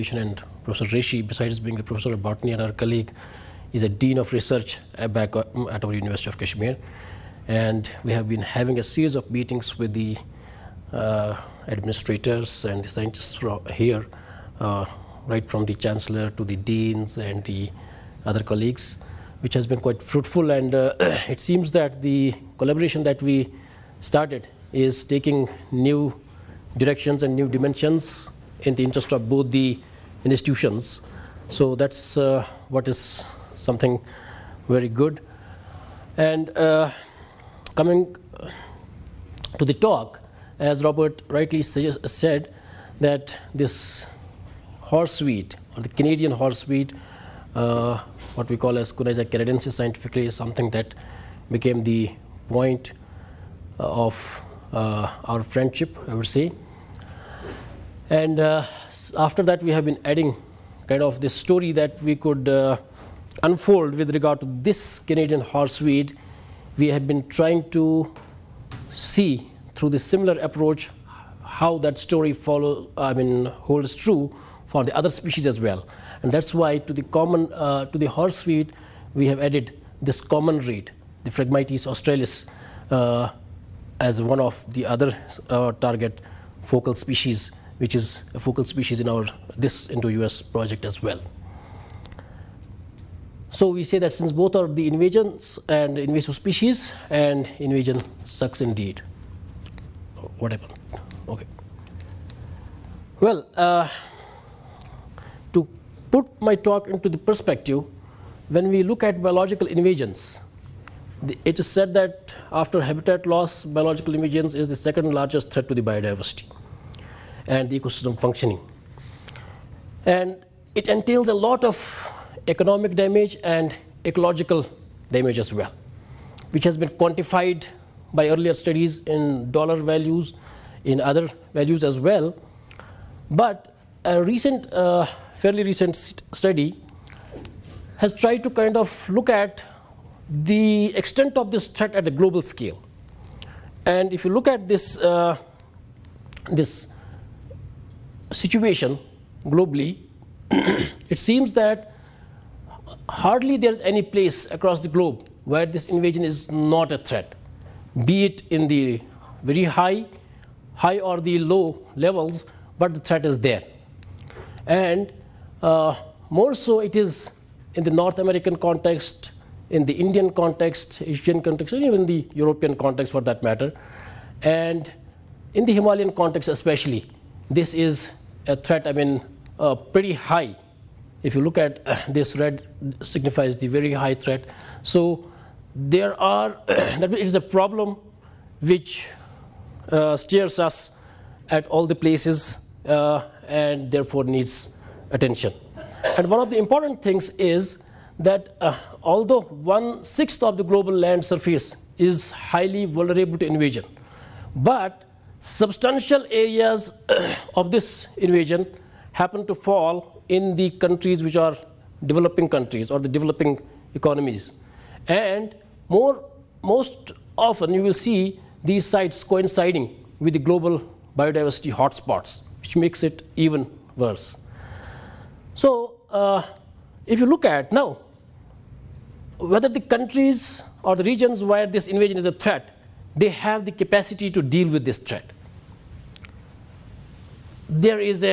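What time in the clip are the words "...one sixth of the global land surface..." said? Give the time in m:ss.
3:19.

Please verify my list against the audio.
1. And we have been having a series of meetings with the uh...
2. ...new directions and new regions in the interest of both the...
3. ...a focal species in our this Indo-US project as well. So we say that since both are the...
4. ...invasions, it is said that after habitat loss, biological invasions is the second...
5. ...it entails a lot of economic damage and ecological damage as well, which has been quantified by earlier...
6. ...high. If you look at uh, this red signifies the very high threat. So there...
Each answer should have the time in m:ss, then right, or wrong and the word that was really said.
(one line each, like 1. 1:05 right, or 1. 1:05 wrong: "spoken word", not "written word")
1. 0:07 right
2. 0:25 wrong: "dimensions", not "regions"
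3. 1:28 right
4. 1:49 right
5. 2:00 right
6. 3:00 right.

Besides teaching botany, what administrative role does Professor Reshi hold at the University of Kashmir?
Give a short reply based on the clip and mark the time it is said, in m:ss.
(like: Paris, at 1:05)
Dean of Research, at 0:03.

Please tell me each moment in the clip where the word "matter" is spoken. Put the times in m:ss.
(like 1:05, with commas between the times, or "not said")
2:53.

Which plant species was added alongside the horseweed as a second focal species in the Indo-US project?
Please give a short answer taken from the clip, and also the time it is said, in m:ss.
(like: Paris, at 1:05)
Phragmites australis, at 1:21.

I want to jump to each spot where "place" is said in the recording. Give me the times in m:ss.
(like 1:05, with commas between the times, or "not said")
2:34, 3:11.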